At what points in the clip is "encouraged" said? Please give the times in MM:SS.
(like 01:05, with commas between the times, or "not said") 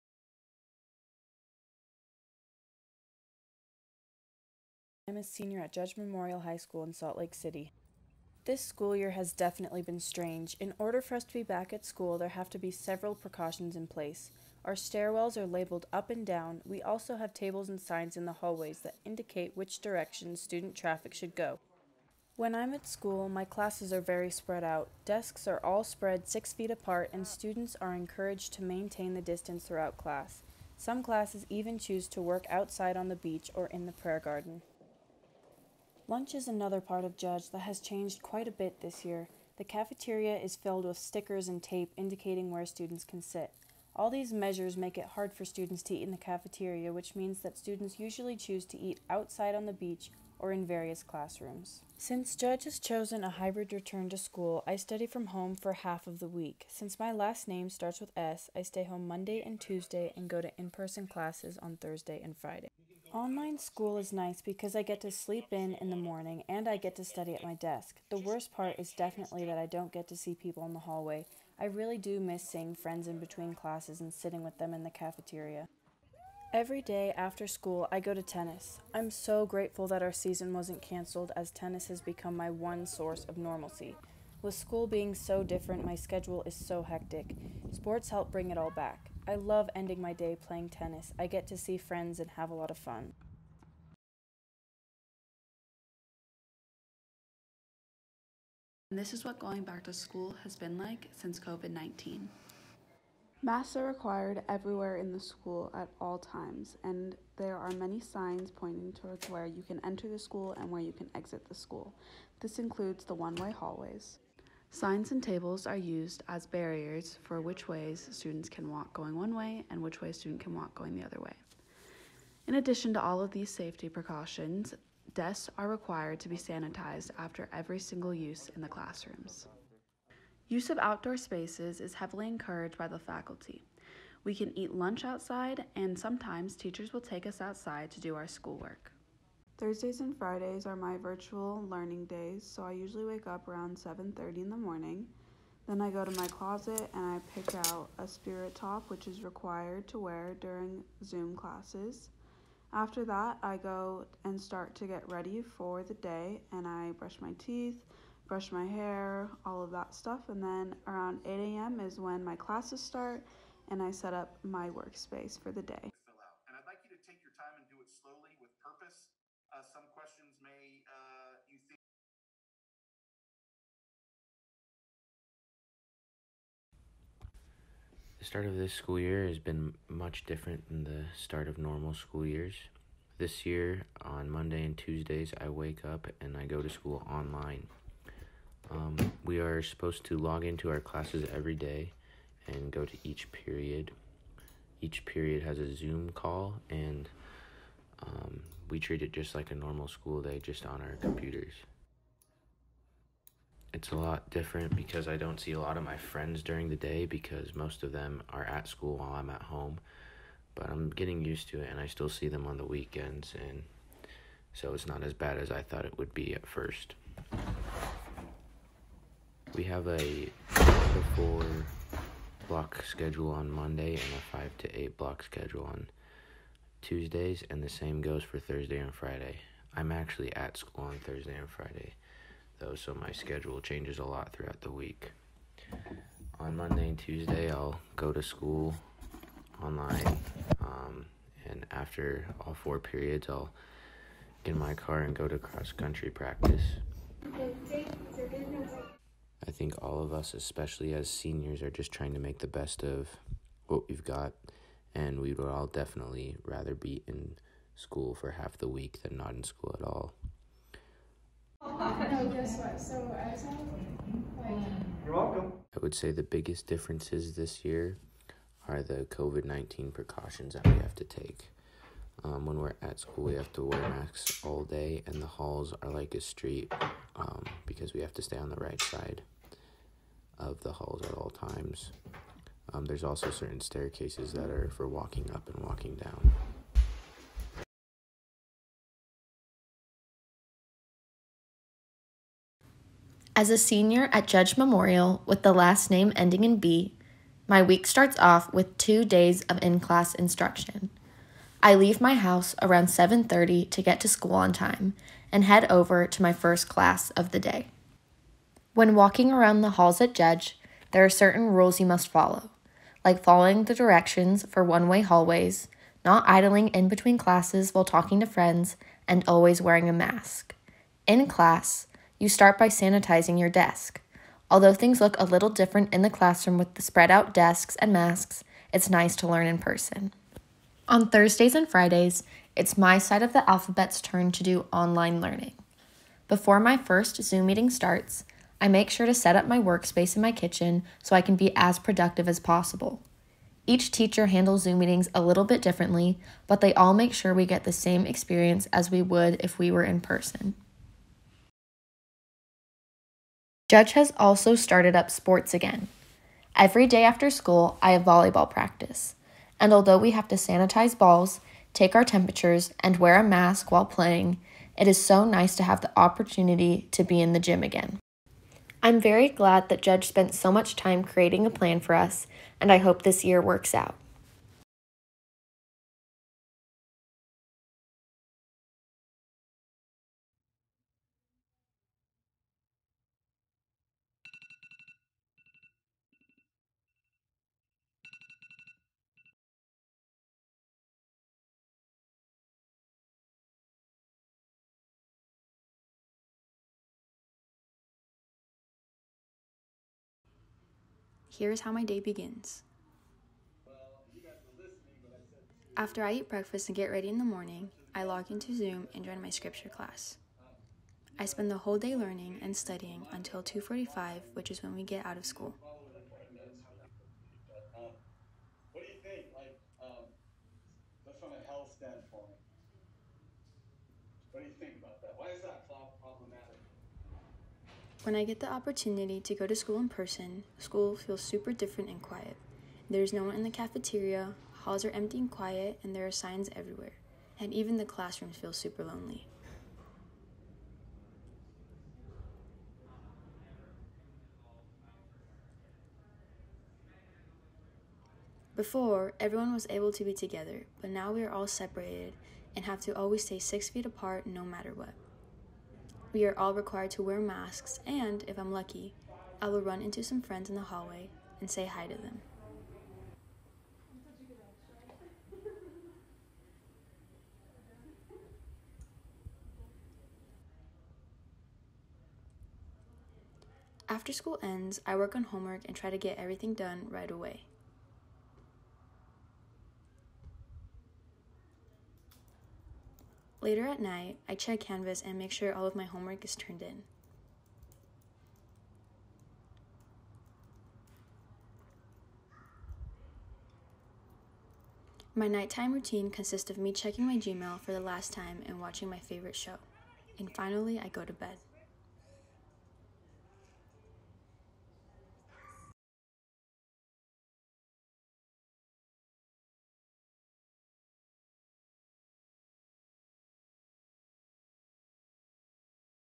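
00:27, 02:12.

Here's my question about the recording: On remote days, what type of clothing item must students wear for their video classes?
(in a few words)
spirit top.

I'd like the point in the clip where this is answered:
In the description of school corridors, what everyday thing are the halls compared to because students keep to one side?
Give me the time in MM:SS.
04:36.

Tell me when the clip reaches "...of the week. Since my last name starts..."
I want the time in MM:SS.
00:56.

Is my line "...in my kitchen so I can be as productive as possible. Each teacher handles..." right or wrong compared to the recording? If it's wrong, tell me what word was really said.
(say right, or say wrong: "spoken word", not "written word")
right.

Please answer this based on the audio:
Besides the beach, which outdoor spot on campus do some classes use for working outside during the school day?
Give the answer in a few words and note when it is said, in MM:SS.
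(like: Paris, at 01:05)
prayer garden, at 00:33.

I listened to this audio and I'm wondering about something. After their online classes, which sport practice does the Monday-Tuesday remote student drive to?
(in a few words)
cross country.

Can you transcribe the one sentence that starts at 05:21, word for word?
In class, you start by sanitizing your desk.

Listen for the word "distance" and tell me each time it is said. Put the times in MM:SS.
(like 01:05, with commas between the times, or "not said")
00:29.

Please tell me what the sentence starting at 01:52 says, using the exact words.
This includes the one way hallways.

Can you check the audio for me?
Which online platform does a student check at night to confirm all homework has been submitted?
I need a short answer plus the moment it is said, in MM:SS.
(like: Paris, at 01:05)
Canvas, at 08:04.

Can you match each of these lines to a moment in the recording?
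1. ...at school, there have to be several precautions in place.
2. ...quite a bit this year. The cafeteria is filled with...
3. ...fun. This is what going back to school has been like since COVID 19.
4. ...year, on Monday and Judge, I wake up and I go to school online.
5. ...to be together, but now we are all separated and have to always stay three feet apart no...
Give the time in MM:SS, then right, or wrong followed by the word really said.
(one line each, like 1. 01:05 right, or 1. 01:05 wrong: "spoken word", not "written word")
1. 00:11 right
2. 00:38 right
3. 01:32 right
4. 03:03 wrong: "Tuesdays", not "Judge"
5. 07:29 wrong: "six", not "three".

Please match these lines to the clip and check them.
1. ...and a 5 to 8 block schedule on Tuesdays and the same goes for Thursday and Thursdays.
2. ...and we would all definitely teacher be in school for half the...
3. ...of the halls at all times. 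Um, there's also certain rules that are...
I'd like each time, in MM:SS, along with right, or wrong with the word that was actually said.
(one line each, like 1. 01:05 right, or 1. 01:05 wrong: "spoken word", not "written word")
1. 03:43 wrong: "Friday", not "Thursdays"
2. 04:14 wrong: "rather", not "teacher"
3. 04:40 wrong: "staircases", not "rules".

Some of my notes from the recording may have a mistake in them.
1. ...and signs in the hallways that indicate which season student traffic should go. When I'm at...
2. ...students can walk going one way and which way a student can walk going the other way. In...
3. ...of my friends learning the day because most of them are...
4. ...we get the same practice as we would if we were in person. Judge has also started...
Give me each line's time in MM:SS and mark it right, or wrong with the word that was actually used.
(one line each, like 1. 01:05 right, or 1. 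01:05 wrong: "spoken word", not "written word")
1. 00:17 wrong: "direction", not "season"
2. 01:58 right
3. 03:25 wrong: "during", not "learning"
4. 05:47 wrong: "experience", not "practice".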